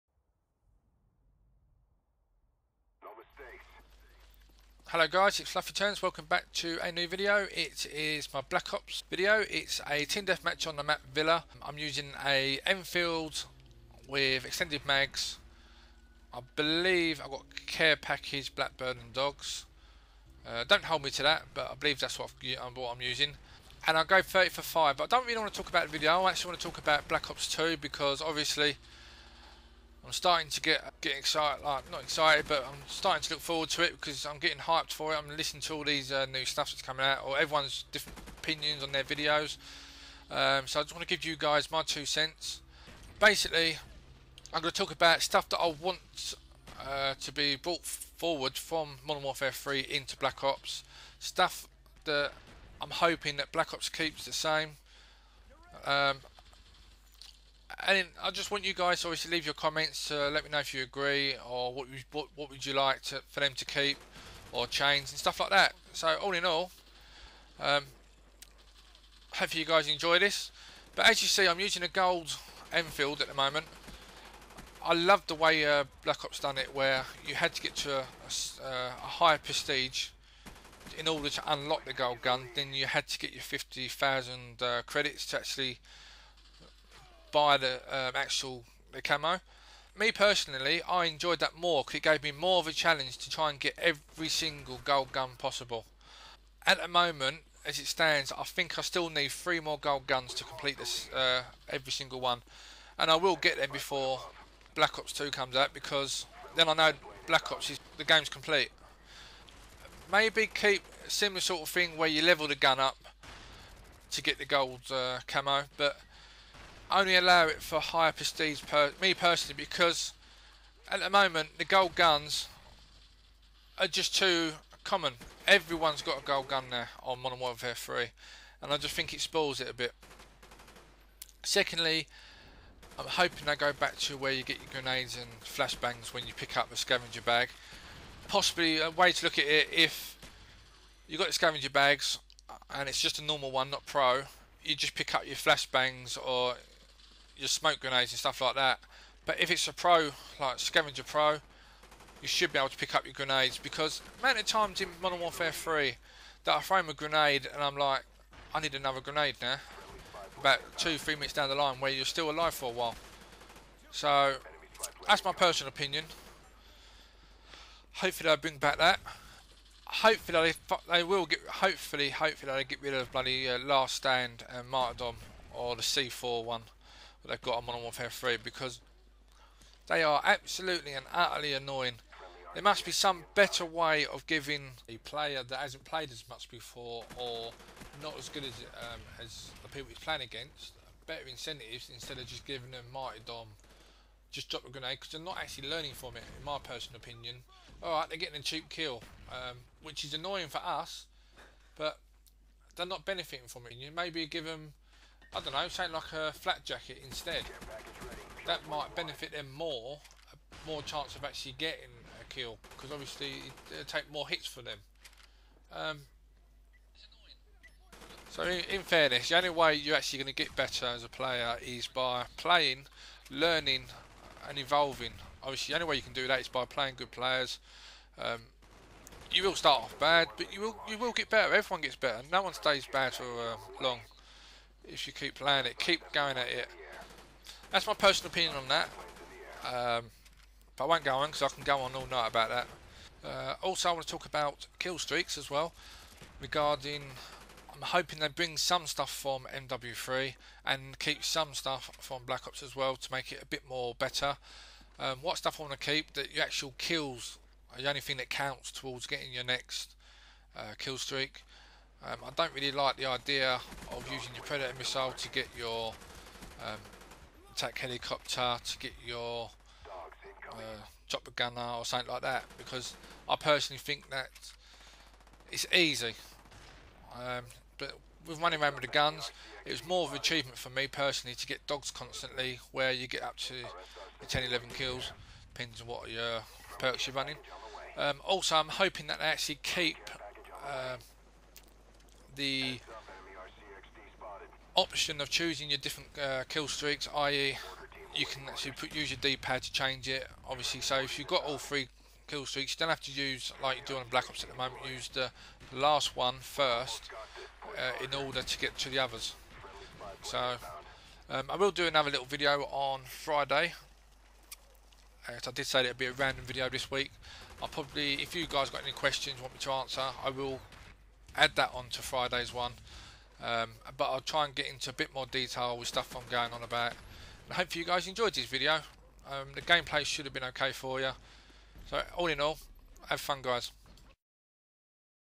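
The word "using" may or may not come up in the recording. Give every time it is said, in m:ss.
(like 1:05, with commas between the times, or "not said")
0:11, 0:23, 1:11, 4:24.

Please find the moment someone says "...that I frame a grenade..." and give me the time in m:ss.
2:36.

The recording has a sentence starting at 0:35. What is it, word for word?
I'm listening to all these uh, new stuff that's coming out, or everyone's different opinions on their videos.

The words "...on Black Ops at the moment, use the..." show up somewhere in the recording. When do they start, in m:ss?
5:03.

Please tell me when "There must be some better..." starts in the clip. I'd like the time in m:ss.
3:02.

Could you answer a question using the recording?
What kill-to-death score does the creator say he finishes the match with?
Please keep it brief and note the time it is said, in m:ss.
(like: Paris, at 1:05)
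30 for 5, at 0:24.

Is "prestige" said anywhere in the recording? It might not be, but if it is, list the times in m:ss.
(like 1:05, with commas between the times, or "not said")
1:19, 1:58.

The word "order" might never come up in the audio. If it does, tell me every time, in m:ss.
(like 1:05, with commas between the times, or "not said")
1:21, 5:08.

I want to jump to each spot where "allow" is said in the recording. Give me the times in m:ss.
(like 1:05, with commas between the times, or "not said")
1:57.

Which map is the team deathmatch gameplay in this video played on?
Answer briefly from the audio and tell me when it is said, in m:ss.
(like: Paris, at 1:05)
Villa, at 0:11.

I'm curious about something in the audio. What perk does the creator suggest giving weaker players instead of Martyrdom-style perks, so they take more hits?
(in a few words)
flat jacket.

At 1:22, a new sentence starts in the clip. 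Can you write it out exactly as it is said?
Then you had to get your 50,000 uh, credits to actually buy the um, actual the camo.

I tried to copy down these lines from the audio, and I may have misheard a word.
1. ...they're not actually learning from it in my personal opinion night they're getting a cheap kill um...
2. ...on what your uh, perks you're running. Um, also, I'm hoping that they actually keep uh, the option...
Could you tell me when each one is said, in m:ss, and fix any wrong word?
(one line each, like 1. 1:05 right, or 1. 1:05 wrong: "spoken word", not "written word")
1. 3:15 wrong: "alright", not "night"
2. 4:45 right.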